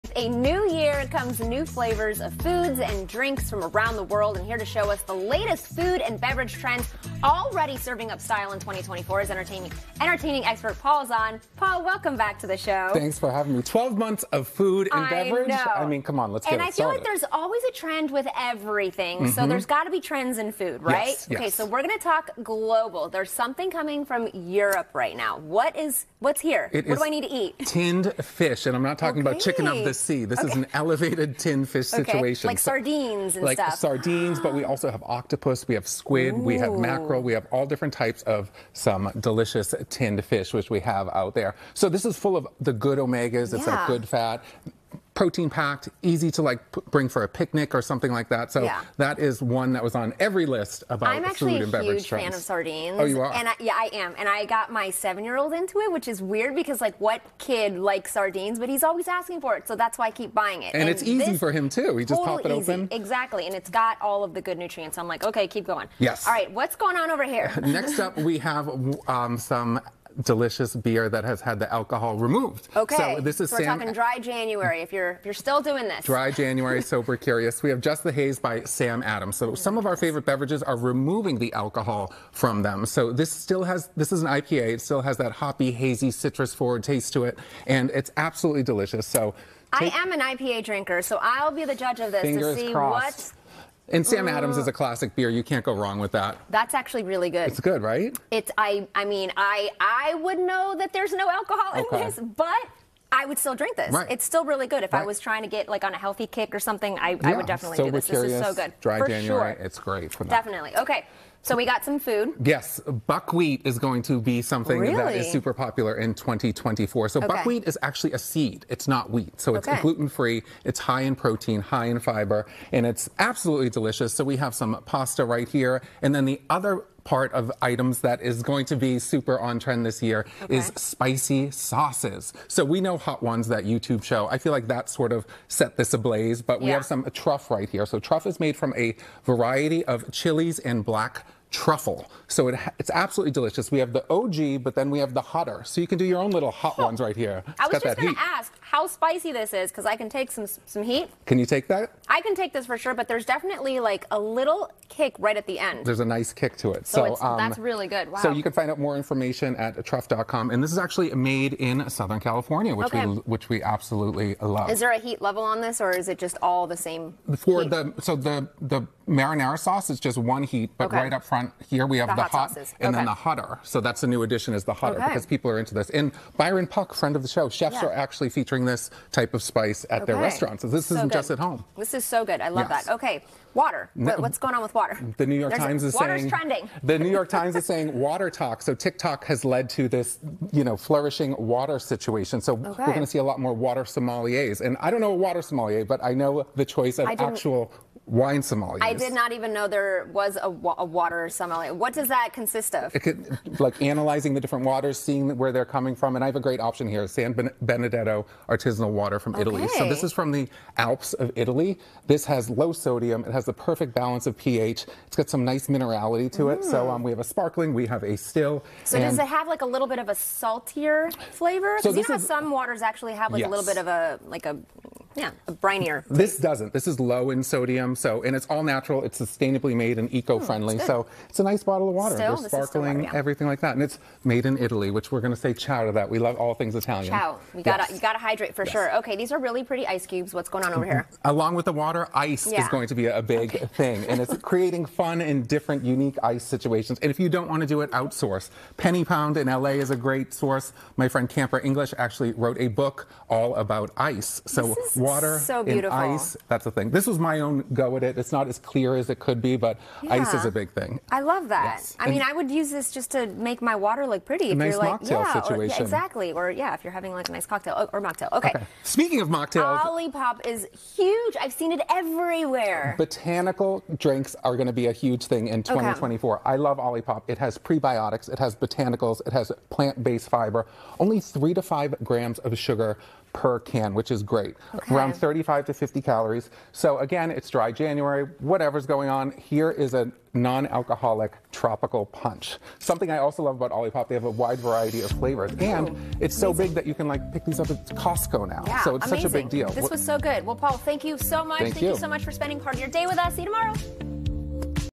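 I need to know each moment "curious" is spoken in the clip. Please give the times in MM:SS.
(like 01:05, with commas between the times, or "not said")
01:17, 01:48.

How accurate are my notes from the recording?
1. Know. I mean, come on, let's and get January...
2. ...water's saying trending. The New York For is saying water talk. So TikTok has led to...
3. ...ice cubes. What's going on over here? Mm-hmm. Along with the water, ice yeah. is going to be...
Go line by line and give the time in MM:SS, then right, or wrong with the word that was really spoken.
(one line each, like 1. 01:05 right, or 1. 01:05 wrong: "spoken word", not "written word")
1. 00:15 wrong: "And", not "January"
2. 03:05 wrong: "Times", not "For"
3. 03:59 right.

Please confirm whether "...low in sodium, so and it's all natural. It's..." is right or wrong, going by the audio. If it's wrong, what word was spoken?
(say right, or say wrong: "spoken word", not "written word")
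right.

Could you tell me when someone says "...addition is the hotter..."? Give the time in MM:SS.
02:54.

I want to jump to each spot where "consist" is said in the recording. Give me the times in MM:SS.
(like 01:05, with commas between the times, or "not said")
03:22.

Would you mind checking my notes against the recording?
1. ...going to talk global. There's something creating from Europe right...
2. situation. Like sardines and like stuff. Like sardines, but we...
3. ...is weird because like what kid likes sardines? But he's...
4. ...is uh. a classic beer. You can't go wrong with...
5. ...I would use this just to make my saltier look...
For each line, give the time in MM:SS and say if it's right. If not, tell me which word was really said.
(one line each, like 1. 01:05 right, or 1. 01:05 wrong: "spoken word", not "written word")
1. 00:21 wrong: "coming", not "creating"
2. 00:32 right
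3. 00:56 right
4. 01:34 right
5. 04:22 wrong: "water", not "saltier".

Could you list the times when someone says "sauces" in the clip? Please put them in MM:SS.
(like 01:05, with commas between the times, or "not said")
02:11, 02:49.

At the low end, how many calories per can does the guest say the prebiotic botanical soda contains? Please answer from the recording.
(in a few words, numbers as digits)
35.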